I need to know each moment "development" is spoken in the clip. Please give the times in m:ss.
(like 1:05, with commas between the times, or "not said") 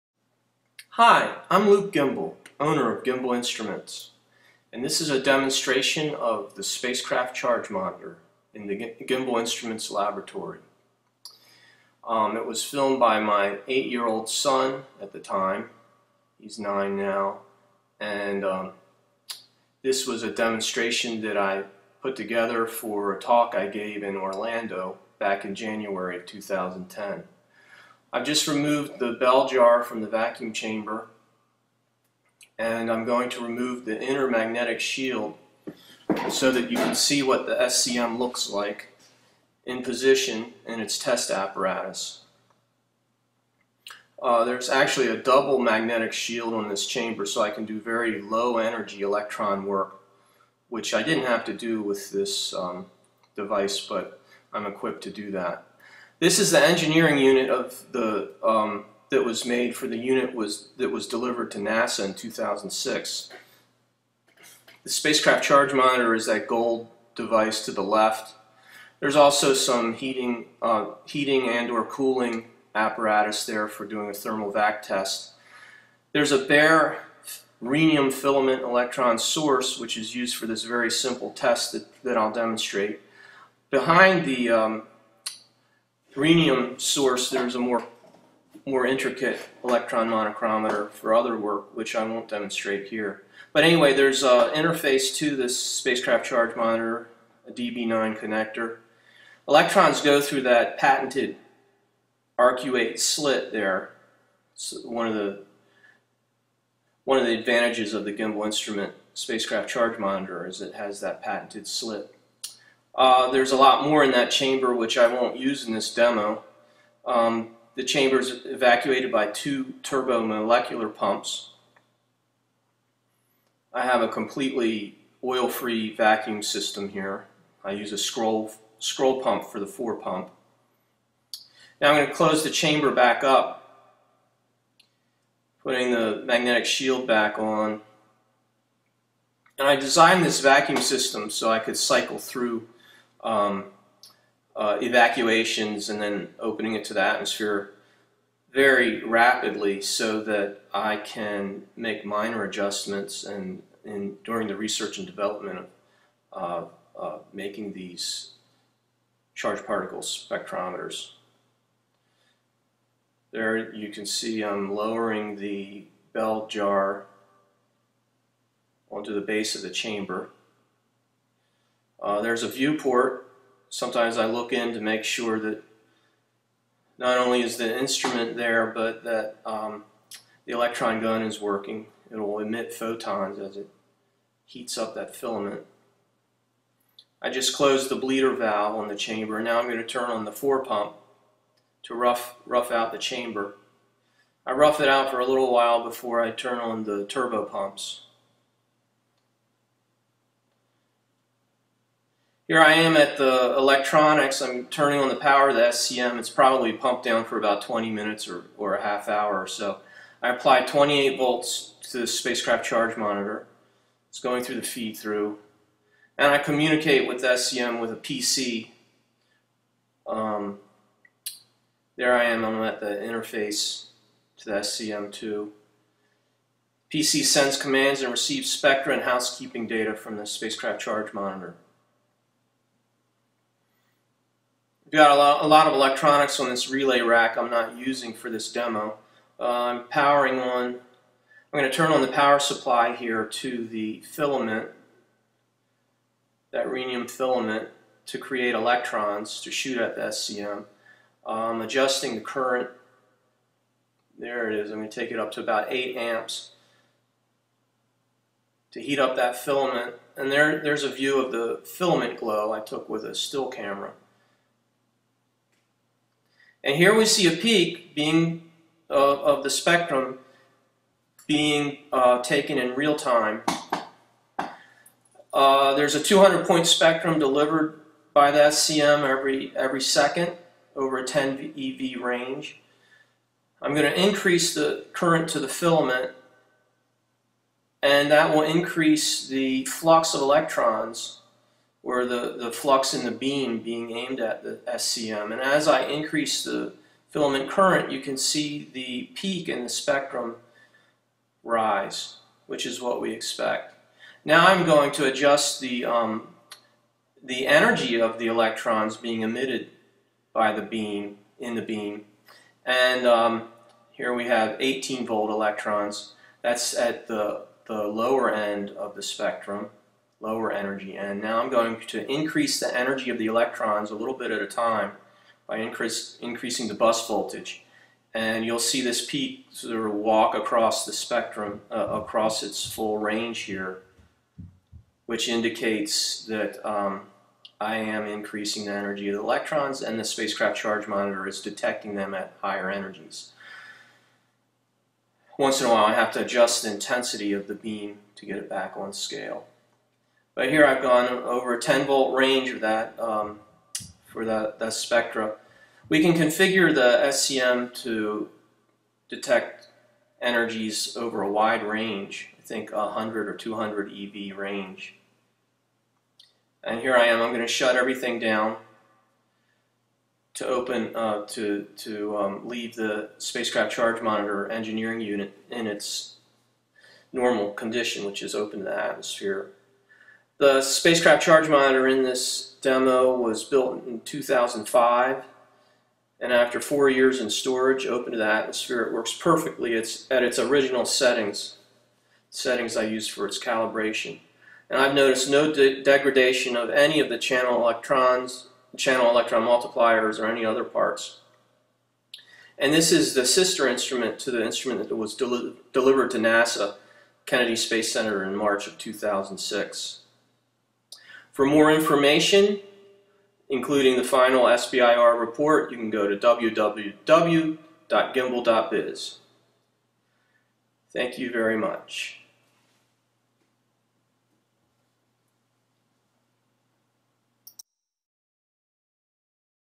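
2:35.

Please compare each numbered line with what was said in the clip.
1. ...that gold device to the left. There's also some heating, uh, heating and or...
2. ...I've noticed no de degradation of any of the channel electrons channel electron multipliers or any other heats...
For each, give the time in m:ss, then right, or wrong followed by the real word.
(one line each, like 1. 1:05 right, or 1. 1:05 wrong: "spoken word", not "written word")
1. 1:06 right
2. 6:34 wrong: "parts", not "heats".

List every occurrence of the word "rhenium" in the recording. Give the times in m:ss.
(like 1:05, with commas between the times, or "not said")
1:17, 1:26, 4:06.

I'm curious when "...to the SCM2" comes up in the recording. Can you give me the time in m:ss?
3:44.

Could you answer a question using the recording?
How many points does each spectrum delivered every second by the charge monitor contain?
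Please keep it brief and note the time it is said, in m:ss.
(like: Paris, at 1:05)
200, at 4:36.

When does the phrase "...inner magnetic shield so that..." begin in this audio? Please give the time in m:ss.
0:34.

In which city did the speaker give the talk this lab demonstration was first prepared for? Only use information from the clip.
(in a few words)
Orlando.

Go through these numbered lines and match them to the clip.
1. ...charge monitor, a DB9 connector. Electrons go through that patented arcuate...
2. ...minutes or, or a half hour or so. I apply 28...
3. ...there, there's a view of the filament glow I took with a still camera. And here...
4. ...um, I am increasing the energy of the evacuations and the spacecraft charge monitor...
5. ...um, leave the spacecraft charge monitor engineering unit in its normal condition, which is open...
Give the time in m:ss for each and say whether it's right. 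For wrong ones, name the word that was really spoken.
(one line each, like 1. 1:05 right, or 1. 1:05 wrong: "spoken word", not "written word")
1. 1:36 right
2. 3:27 right
3. 4:20 right
4. 5:36 wrong: "electrons", not "evacuations"
5. 6:12 right.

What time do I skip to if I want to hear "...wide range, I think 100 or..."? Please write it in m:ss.
6:01.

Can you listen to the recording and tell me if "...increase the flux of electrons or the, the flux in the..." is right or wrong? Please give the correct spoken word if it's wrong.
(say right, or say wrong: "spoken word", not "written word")
right.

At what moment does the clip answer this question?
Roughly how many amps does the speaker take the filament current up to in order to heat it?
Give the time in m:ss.
4:15.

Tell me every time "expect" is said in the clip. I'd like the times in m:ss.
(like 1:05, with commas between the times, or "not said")
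5:03.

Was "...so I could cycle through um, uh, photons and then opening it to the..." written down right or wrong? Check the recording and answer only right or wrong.
wrong.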